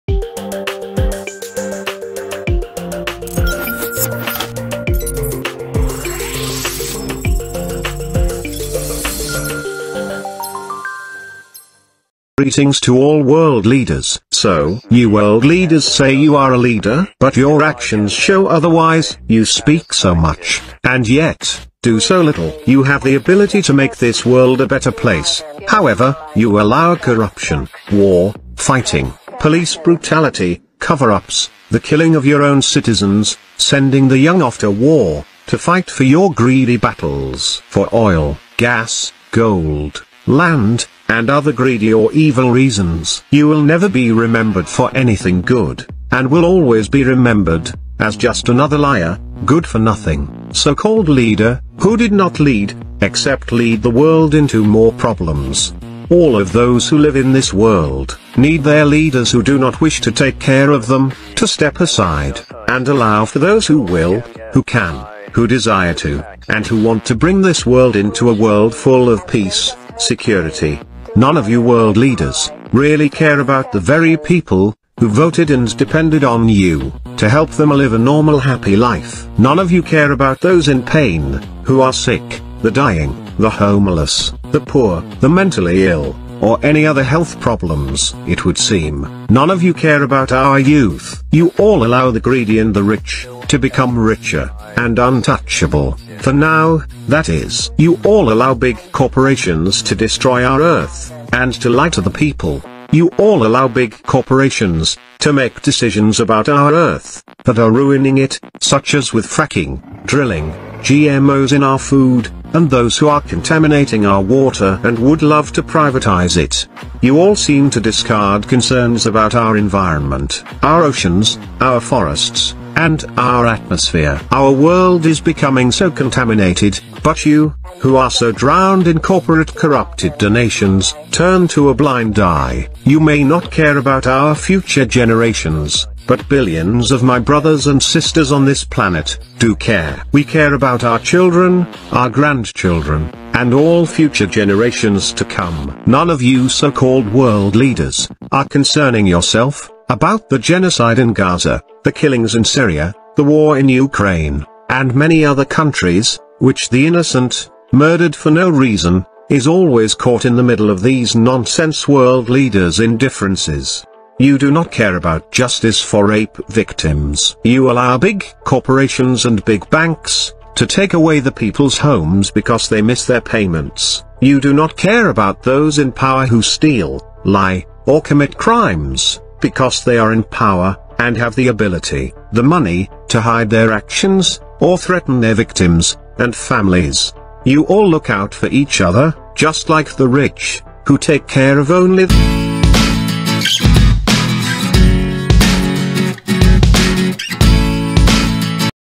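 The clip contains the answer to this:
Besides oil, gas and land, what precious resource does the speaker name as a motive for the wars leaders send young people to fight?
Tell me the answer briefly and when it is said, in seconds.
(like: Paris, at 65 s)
Gold, at 39 s.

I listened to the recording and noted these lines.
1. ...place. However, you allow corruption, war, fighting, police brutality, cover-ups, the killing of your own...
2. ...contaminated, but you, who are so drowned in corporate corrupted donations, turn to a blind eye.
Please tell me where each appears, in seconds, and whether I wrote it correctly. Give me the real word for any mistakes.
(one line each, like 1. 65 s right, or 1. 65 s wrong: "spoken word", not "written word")
1. 24 s right
2. 125 s right.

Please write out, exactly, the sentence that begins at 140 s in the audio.
We care about our children, our grandchildren, and all future generations to come.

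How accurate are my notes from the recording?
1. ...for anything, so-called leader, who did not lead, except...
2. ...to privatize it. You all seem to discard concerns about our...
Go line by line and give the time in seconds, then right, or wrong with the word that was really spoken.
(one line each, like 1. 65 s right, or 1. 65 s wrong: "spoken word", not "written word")
1. 49 s wrong: "nothing", not "anything"
2. 115 s right.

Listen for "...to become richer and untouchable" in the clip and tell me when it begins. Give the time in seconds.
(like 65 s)
93 s.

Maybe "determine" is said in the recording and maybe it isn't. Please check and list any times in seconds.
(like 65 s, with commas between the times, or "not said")
not said.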